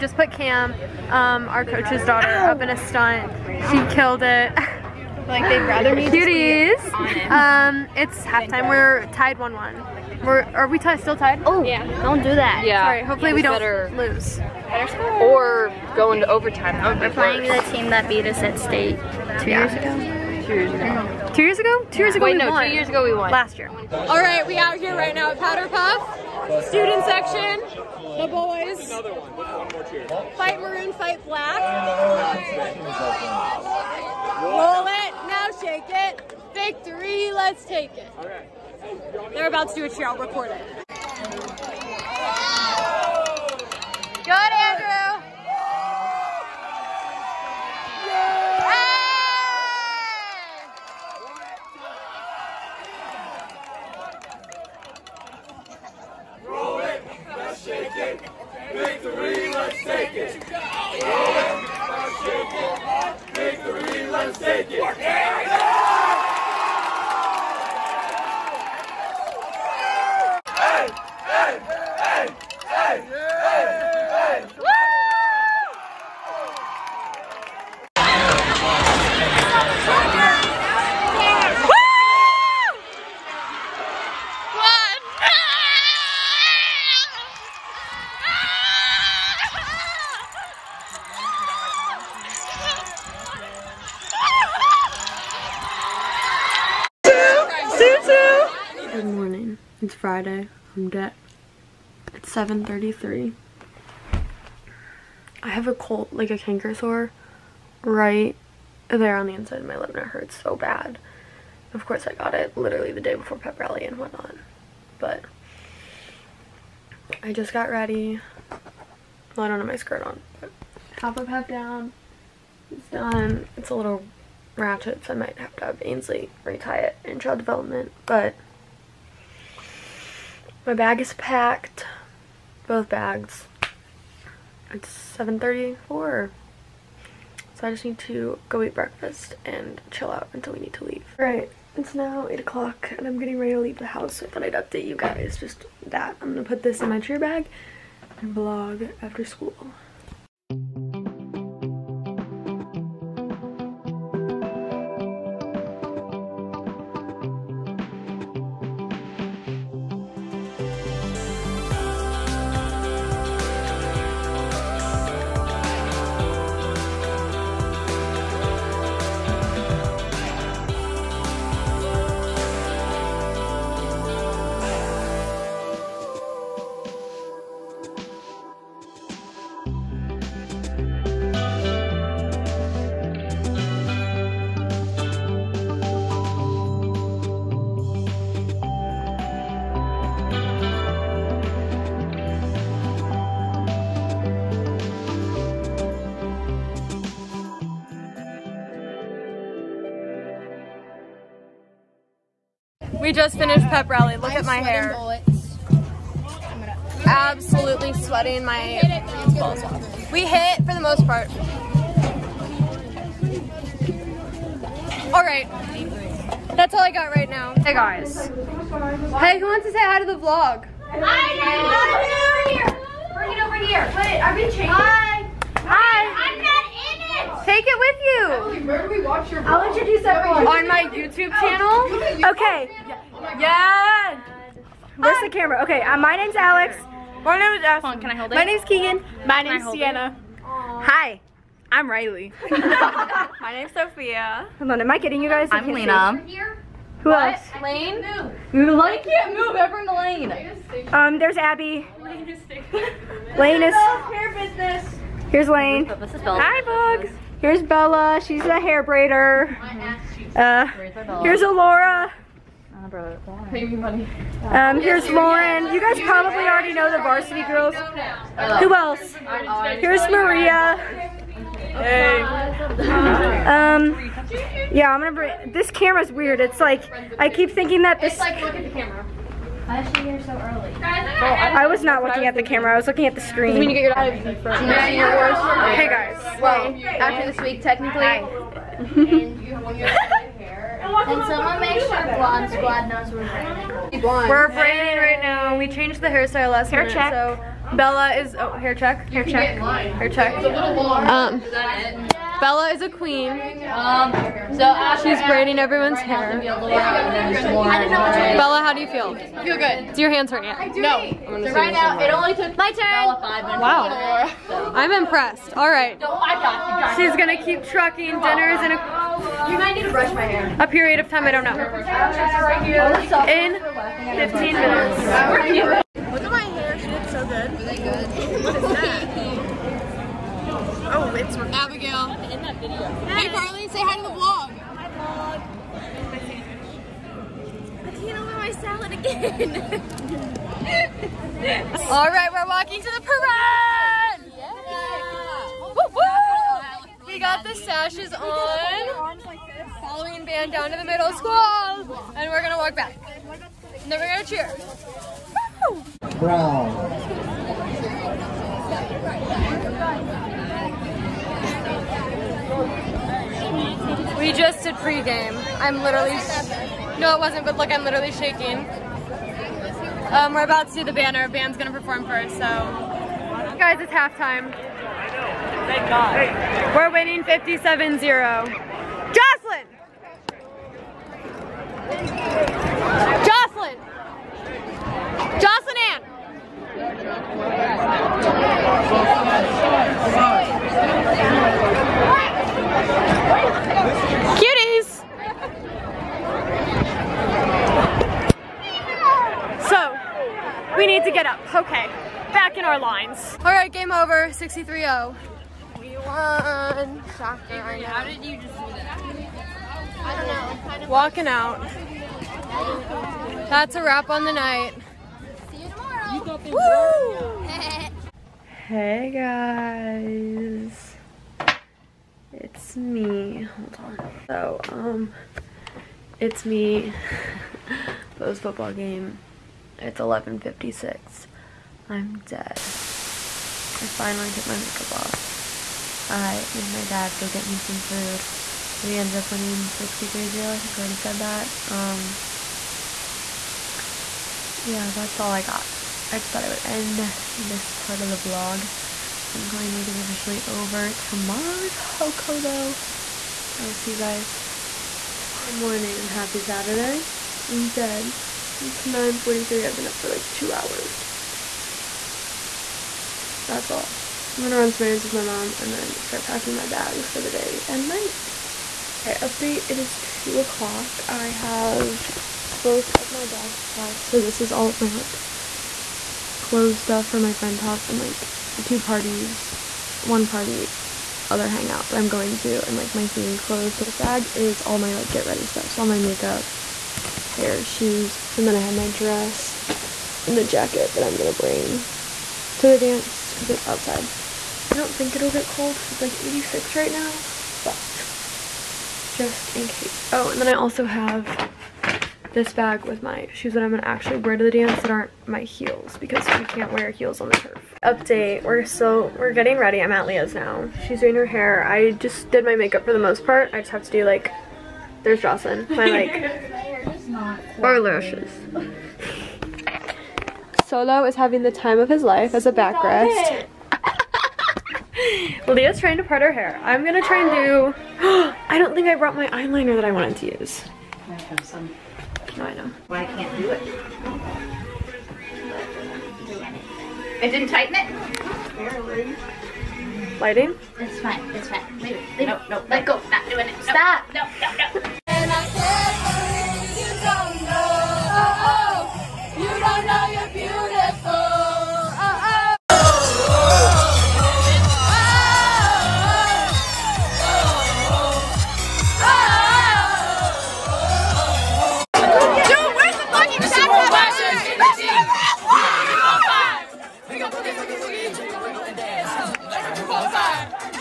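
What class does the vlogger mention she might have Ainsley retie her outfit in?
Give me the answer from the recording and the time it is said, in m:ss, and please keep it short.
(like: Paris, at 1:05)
child development, at 2:07.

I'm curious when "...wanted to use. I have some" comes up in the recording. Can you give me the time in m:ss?
8:49.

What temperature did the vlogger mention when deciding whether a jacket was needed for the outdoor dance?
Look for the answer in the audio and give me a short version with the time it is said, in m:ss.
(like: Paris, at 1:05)
86, at 8:16.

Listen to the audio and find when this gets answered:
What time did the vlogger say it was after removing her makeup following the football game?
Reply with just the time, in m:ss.
7:09.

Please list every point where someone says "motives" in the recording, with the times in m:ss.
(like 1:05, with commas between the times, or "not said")
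not said.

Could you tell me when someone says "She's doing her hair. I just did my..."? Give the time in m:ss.
8:30.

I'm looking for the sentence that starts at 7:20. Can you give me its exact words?
I think I already said that.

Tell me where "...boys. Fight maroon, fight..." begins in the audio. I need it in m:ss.
0:28.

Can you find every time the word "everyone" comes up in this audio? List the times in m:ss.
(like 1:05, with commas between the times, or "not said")
3:50, 4:09, 5:05.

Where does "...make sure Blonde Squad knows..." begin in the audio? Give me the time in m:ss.
4:51.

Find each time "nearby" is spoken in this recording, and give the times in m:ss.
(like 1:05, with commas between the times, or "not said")
not said.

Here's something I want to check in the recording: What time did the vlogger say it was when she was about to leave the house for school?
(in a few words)
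8 o'clock.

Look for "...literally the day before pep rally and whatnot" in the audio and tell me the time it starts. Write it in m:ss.
1:52.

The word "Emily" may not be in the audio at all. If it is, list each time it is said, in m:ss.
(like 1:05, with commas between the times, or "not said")
3:48.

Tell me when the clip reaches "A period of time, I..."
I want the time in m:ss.
5:20.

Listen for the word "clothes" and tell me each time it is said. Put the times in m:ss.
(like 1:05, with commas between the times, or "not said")
7:56, 8:03.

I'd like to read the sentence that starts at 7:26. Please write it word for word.
I just thought I would end this part of the vlog.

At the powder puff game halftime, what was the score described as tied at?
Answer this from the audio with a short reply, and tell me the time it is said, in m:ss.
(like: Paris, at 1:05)
1-1, at 0:09.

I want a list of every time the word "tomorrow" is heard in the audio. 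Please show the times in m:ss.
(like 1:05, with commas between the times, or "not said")
6:55, 7:31, 7:35.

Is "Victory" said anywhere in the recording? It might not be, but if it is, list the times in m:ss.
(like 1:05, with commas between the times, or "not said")
0:36, 0:45, 0:58.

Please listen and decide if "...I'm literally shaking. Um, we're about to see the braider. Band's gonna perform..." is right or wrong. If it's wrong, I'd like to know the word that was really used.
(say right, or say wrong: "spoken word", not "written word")
wrong: "banner", not "braider".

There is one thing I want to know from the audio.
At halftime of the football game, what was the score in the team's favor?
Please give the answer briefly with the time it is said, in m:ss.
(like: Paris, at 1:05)
57-0, at 6:17.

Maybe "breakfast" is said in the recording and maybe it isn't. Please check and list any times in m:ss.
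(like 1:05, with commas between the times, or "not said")
2:18.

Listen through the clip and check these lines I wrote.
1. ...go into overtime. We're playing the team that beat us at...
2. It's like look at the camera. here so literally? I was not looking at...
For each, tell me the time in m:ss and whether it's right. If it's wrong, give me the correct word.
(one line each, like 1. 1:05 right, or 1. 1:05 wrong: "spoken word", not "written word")
1. 0:15 right
2. 4:38 wrong: "early", not "literally".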